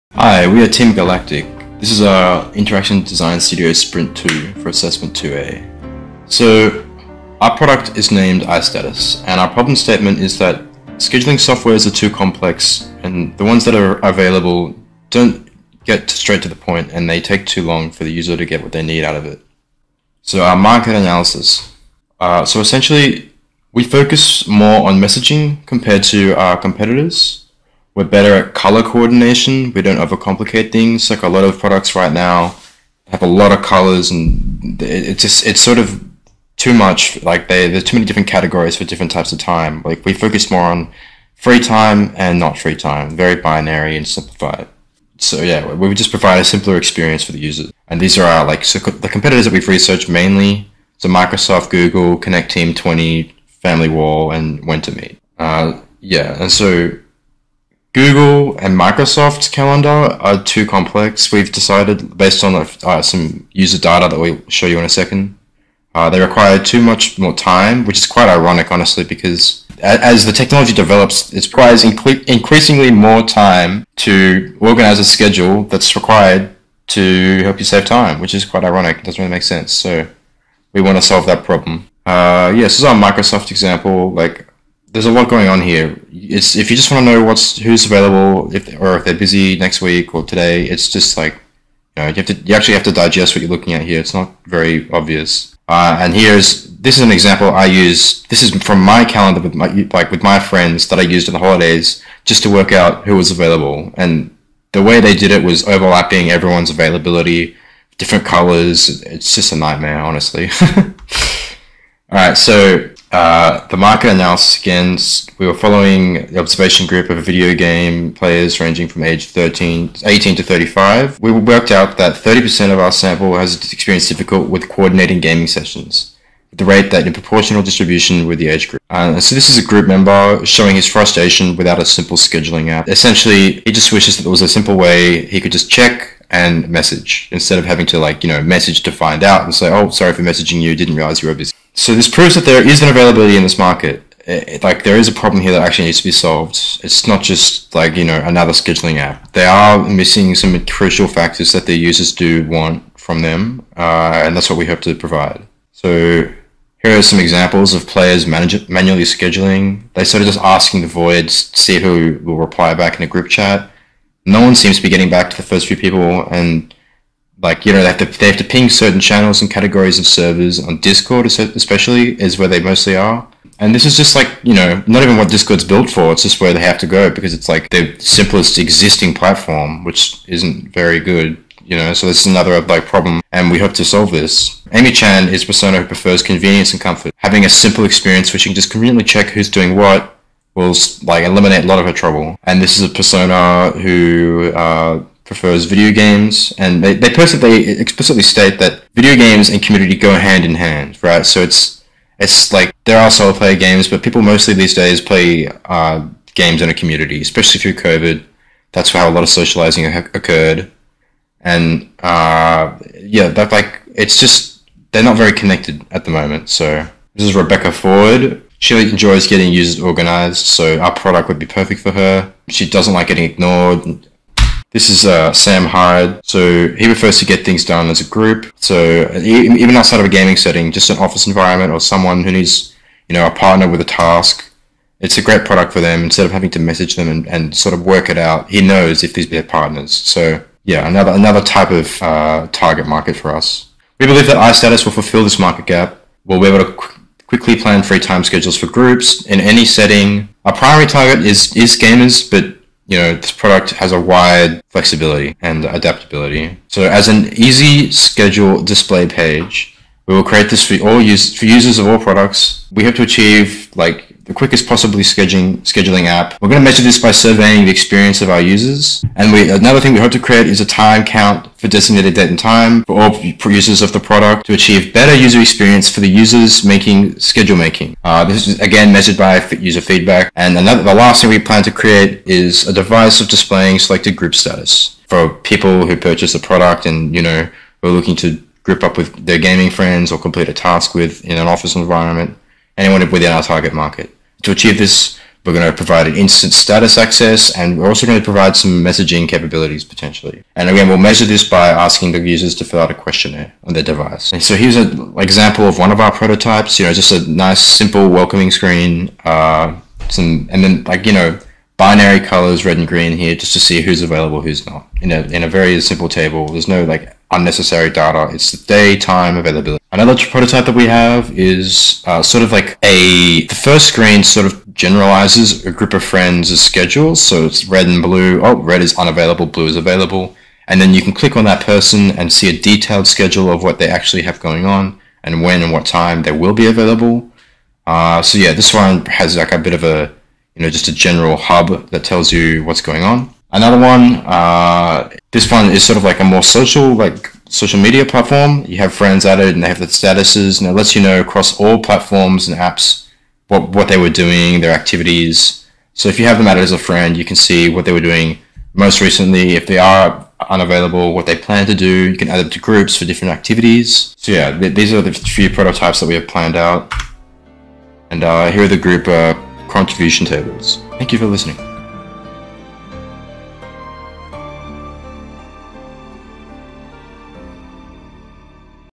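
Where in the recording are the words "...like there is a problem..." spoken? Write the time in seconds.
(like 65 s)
144 s.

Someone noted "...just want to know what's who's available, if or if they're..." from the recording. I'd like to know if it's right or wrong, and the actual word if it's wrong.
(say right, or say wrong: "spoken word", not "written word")
right.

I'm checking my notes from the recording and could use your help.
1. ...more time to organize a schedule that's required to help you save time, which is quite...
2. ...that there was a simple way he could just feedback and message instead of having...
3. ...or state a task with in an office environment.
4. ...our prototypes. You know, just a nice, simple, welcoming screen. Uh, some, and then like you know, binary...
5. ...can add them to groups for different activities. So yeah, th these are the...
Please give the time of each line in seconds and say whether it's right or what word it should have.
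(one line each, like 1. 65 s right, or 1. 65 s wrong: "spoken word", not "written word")
1. 72 s right
2. 134 s wrong: "check", not "feedback"
3. 290 s wrong: "complete", not "state"
4. 305 s right
5. 362 s right.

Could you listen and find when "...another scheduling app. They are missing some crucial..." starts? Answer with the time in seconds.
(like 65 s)
148 s.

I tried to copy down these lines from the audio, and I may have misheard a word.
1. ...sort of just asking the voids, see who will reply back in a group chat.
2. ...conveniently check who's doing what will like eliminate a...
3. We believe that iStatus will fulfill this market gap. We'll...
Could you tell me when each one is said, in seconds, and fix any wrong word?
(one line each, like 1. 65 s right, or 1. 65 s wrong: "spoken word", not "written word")
1. 160 s right
2. 188 s right
3. 243 s right.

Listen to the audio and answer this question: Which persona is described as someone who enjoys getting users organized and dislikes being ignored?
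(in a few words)
Rebecca Ford.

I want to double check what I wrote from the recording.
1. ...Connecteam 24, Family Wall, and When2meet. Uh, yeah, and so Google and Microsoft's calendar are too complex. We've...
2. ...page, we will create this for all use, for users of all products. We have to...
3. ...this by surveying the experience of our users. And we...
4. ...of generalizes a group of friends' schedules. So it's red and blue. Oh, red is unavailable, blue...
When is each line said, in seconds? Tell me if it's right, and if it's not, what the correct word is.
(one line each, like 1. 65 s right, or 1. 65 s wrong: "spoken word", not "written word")
1. 52 s wrong: "20", not "24"
2. 259 s right
3. 266 s right
4. 324 s right.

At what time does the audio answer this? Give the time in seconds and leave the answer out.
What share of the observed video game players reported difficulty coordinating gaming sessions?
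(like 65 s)
122 s.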